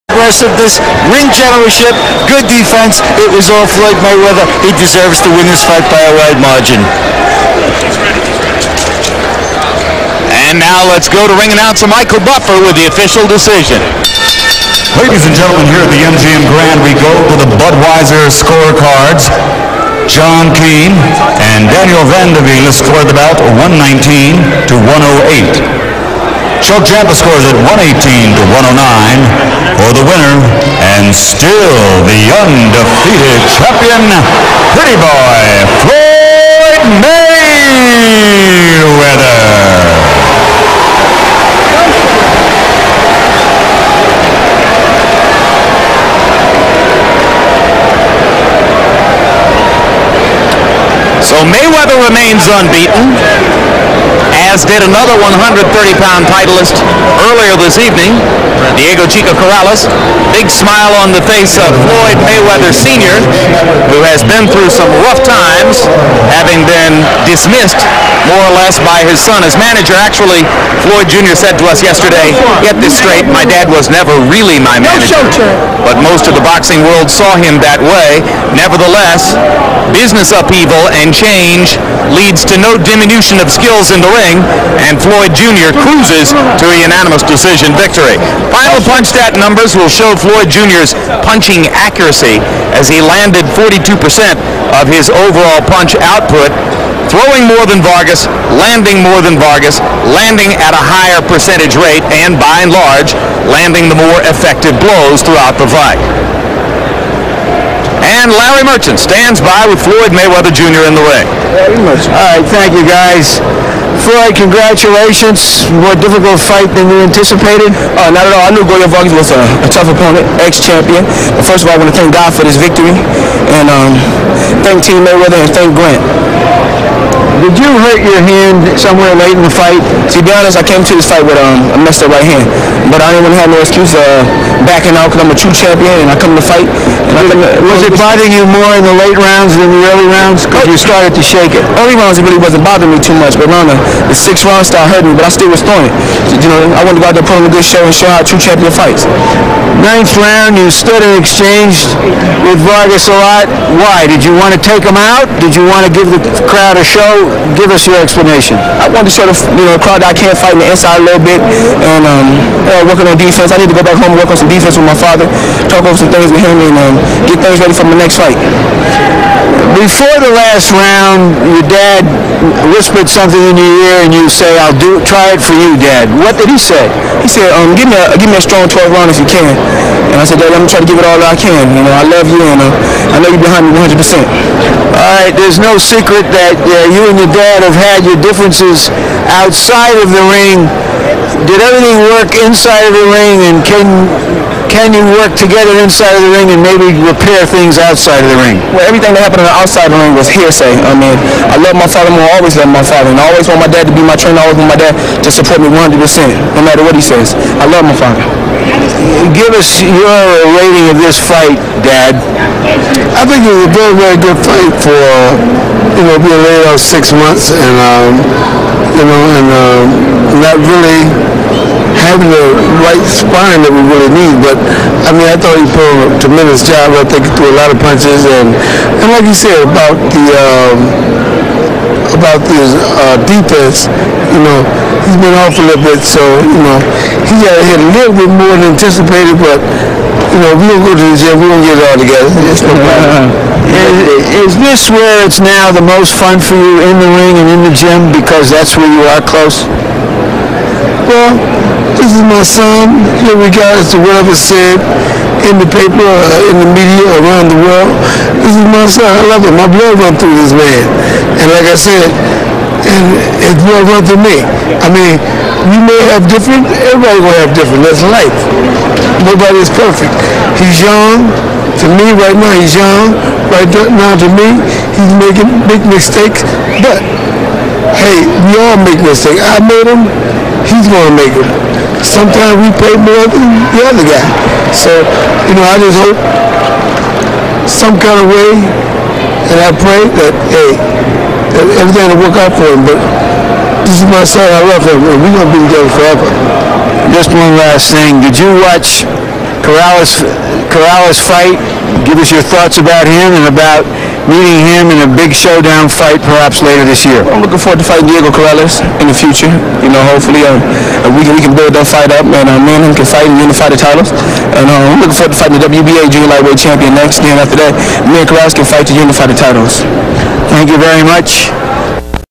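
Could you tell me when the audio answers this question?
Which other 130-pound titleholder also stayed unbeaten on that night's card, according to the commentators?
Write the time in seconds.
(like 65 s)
58 s.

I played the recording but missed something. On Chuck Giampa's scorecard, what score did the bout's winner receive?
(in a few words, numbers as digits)
118 to 109.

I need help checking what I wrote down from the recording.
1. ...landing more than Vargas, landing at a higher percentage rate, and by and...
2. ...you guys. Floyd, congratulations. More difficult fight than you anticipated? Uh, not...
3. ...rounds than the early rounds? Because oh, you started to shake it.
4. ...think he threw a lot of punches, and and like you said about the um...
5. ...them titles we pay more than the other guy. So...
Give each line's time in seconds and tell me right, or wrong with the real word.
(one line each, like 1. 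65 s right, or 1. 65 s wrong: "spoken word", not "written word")
1. 98 s right
2. 112 s right
3. 139 s right
4. 227 s right
5. 281 s wrong: "sometimes", not "titles".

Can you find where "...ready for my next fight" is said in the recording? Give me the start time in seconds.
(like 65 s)
167 s.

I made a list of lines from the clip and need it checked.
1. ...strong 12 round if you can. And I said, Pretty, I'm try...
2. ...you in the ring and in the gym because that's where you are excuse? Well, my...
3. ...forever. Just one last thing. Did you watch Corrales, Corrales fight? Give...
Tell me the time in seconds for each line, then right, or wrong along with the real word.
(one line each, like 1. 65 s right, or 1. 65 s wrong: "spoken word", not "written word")
1. 178 s wrong: "Dad", not "Pretty"
2. 246 s wrong: "close", not "excuse"
3. 295 s right.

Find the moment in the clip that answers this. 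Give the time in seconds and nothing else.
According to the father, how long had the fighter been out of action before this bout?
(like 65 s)
216 s.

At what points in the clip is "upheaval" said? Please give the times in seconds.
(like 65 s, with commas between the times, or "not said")
80 s.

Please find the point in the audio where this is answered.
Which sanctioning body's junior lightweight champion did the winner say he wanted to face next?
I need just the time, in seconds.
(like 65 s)
315 s.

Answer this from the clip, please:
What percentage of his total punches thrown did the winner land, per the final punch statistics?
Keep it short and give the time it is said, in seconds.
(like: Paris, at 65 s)
42%, at 93 s.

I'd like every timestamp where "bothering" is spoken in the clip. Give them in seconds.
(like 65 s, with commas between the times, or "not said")
137 s, 142 s.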